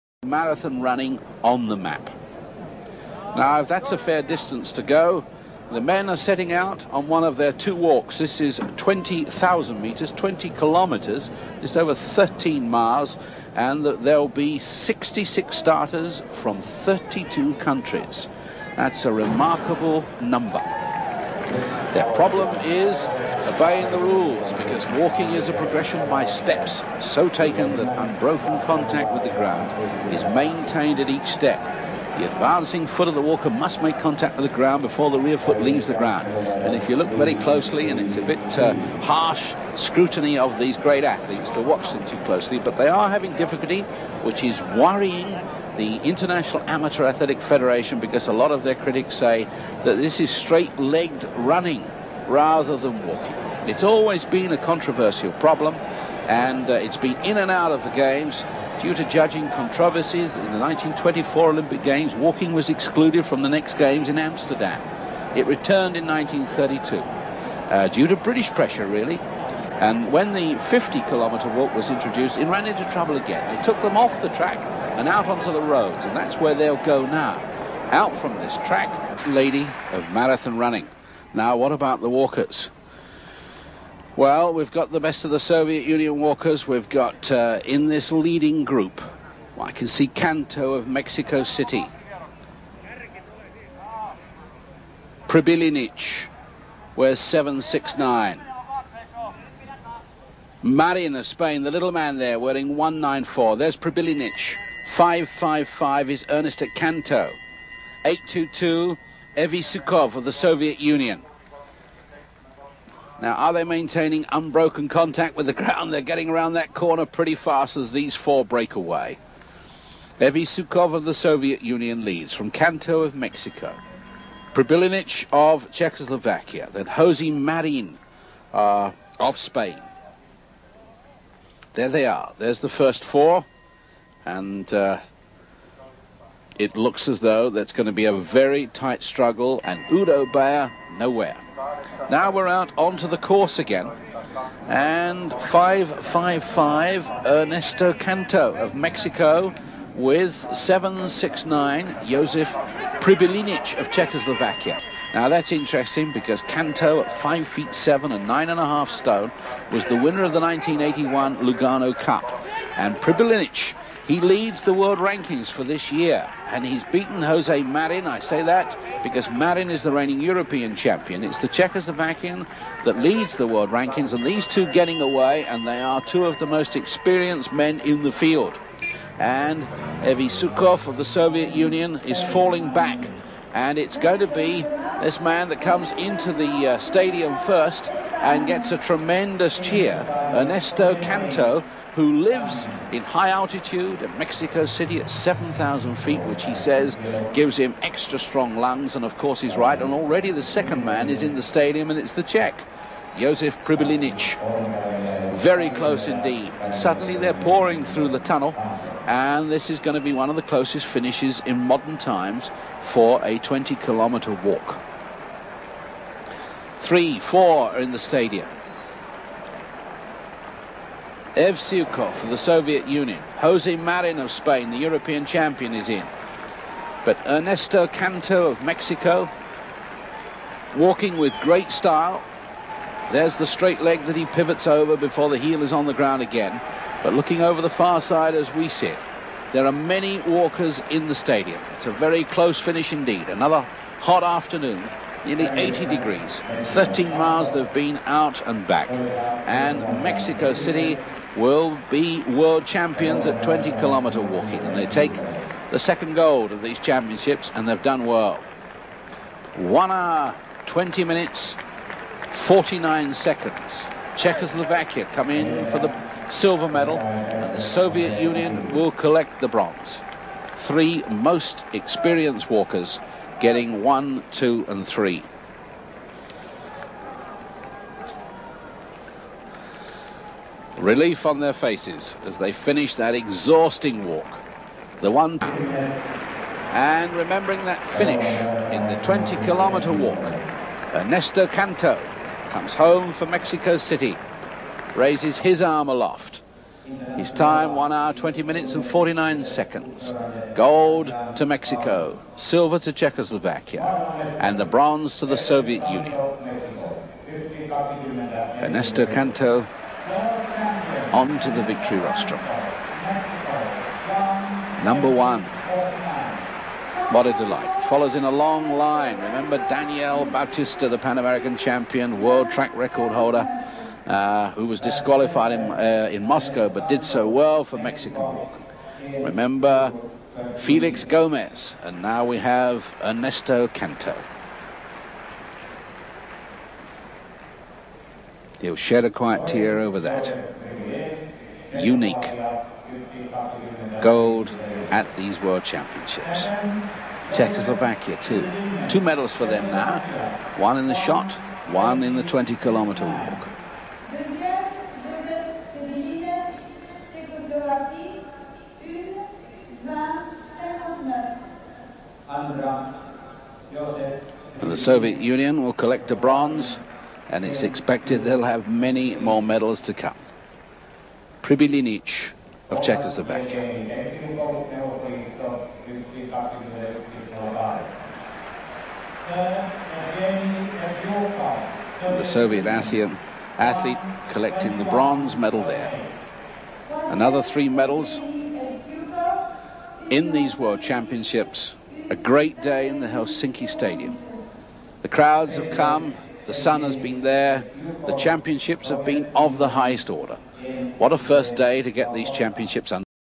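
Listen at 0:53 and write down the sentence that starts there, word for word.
It's always been a controversial problem and uh, it's been in and out of the games due to judging controversies.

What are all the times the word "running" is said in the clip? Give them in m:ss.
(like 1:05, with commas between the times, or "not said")
0:00, 0:51, 1:20.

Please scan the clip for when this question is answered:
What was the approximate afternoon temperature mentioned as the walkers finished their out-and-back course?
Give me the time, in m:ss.
4:05.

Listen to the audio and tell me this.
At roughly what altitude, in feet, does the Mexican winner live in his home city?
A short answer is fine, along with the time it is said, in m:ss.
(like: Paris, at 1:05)
7,000 feet, at 3:15.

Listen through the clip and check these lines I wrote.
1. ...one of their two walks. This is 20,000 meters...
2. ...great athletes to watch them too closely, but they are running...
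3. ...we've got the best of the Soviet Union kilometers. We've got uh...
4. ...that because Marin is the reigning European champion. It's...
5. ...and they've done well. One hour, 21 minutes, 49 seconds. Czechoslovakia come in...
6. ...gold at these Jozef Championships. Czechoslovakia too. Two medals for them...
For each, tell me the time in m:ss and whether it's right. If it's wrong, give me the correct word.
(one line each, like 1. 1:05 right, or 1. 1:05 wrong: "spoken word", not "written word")
1. 0:07 right
2. 0:40 wrong: "having", not "running"
3. 1:24 wrong: "walkers", not "kilometers"
4. 2:48 right
5. 4:17 wrong: "20", not "21"
6. 5:44 wrong: "World", not "Jozef".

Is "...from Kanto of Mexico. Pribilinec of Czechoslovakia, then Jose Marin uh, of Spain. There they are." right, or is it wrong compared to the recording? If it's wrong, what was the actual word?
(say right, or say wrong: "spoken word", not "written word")
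right.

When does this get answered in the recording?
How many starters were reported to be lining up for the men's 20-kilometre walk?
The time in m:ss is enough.
0:14.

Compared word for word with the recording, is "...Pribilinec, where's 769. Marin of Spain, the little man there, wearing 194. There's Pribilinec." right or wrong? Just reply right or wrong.
right.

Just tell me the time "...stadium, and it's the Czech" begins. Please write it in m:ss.
3:21.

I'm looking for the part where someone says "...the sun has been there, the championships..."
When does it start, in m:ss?
6:36.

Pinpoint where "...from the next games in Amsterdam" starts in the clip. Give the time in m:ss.
1:03.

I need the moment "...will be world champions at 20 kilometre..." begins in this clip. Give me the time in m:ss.
4:11.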